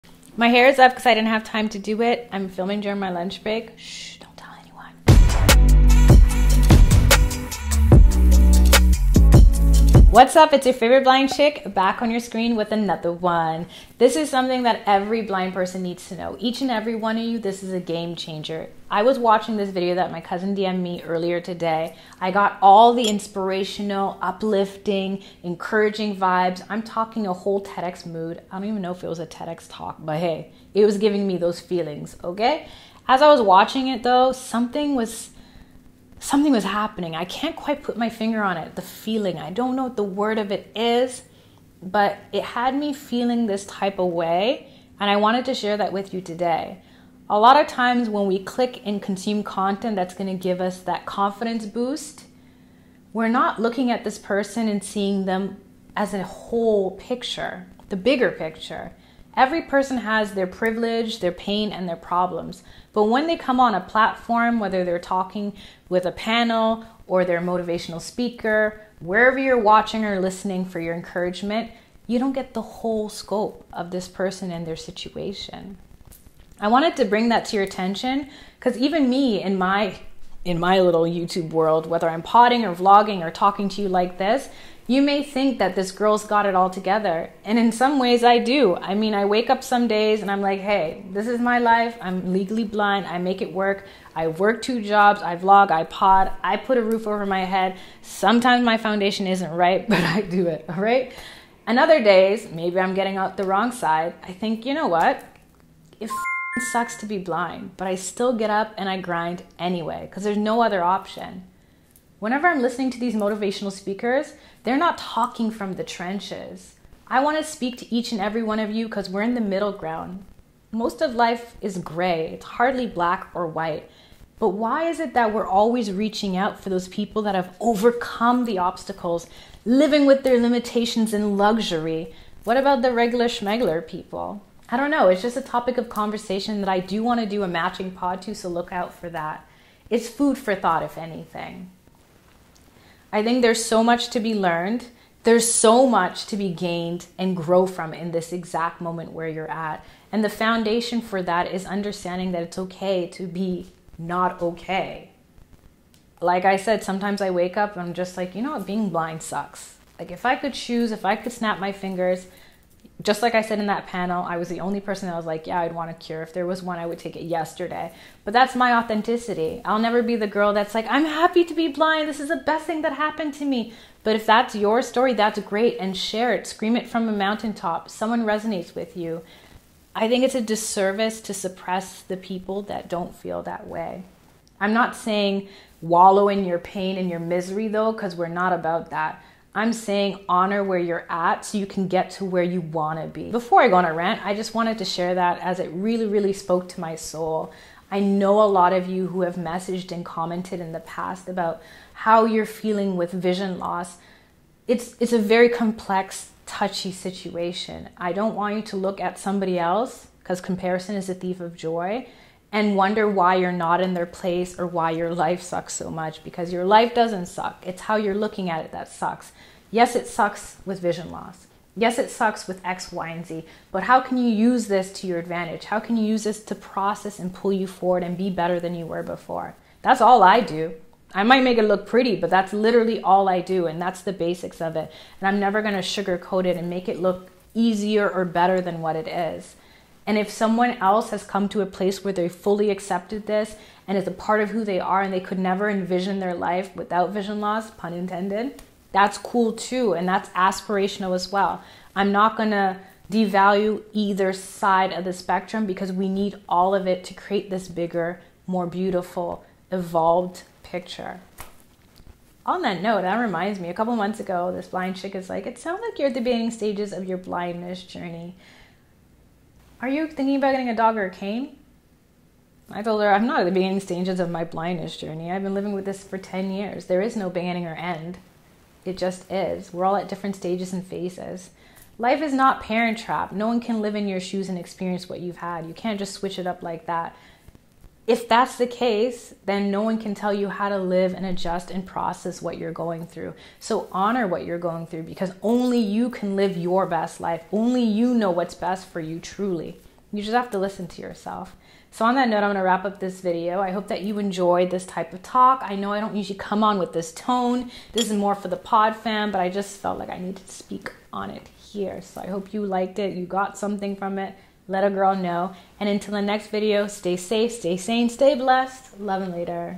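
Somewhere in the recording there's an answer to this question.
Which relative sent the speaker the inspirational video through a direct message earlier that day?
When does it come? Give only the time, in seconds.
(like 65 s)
20 s.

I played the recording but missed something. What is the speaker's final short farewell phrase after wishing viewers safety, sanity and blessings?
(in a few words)
Love and later.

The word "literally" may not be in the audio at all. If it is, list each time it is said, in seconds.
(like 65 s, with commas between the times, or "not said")
232 s.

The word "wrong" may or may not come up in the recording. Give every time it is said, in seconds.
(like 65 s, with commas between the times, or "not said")
103 s.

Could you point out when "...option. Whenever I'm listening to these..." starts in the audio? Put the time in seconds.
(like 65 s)
110 s.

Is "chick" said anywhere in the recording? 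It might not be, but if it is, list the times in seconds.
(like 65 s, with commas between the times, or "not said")
11 s, 264 s.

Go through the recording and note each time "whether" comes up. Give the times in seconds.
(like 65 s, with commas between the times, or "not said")
64 s, 81 s.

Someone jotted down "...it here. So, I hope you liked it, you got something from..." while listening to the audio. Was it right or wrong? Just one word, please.
right.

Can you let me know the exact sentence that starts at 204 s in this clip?
It's, it's a very complex, touchy situation.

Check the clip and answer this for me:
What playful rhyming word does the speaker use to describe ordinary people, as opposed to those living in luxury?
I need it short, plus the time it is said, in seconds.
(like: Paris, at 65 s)
Schmegler, at 133 s.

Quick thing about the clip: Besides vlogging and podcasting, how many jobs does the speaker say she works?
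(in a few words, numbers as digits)
2.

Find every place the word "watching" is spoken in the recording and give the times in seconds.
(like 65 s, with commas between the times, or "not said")
19 s, 33 s, 69 s.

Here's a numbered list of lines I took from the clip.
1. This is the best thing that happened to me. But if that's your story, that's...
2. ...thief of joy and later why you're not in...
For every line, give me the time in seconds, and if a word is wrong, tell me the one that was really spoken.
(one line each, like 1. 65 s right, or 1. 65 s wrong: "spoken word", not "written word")
1. 172 s right
2. 211 s wrong: "wonder", not "later".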